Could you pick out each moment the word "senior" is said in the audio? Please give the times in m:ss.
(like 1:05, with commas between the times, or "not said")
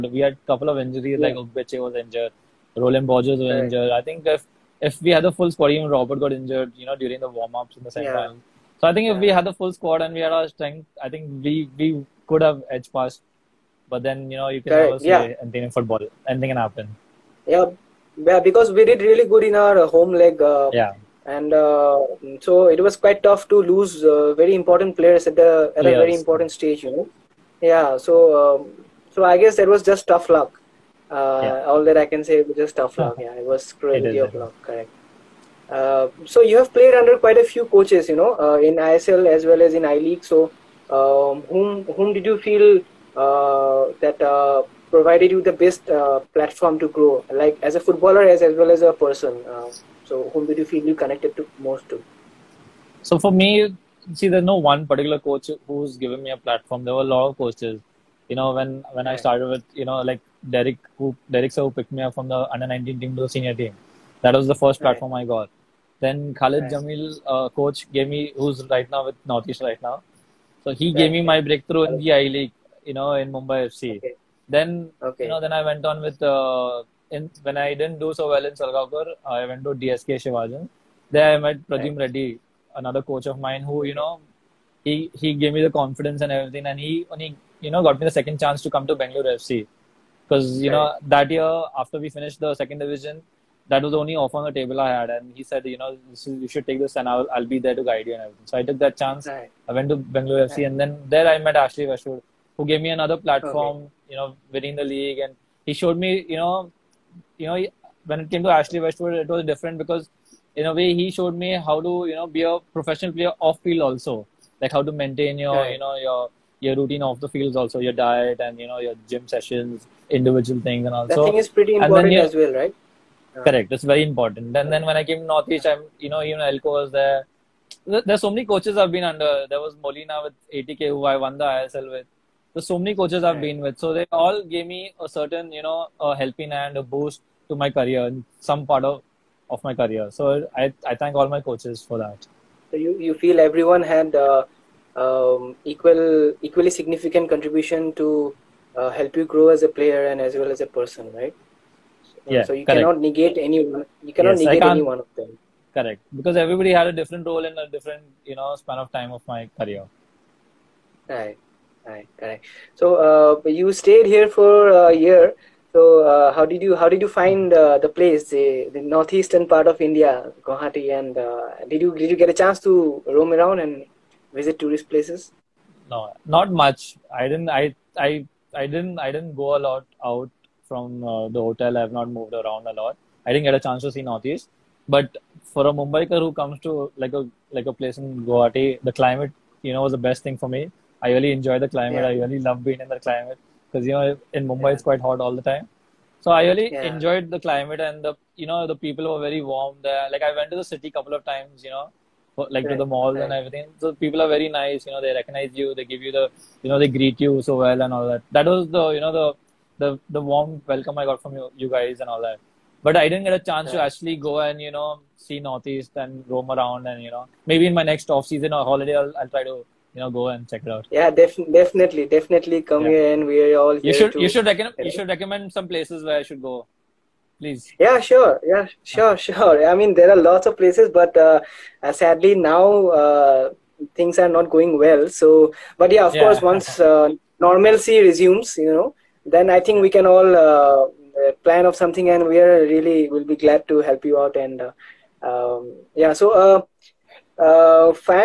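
1:03.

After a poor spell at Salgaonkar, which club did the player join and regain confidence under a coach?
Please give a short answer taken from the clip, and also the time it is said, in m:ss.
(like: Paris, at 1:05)
DSK Shivajians, at 1:19.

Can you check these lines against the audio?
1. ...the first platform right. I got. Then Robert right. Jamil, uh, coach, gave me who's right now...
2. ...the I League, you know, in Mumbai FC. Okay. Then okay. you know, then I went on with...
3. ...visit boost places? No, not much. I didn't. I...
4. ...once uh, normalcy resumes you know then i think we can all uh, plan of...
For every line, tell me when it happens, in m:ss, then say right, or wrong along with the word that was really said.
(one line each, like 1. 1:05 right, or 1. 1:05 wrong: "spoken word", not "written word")
1. 1:04 wrong: "Khalid", not "Robert"
2. 1:11 right
3. 2:54 wrong: "tourist", not "boost"
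4. 3:56 right.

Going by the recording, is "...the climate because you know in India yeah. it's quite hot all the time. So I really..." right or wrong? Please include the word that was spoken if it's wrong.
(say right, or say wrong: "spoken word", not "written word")
wrong: "Mumbai", not "India".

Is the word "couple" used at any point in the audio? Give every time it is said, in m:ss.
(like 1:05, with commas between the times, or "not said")
0:00, 3:20.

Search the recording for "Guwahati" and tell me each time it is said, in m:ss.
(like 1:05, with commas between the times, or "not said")
2:50, 3:08.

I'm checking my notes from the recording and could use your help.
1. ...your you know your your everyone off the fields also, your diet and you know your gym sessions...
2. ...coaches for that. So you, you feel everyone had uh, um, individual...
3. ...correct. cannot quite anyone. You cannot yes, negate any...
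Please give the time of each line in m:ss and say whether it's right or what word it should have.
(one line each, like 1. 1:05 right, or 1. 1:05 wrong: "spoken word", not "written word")
1. 1:55 wrong: "routine", not "everyone"
2. 2:21 wrong: "equal", not "individual"
3. 2:32 wrong: "negate", not "quite".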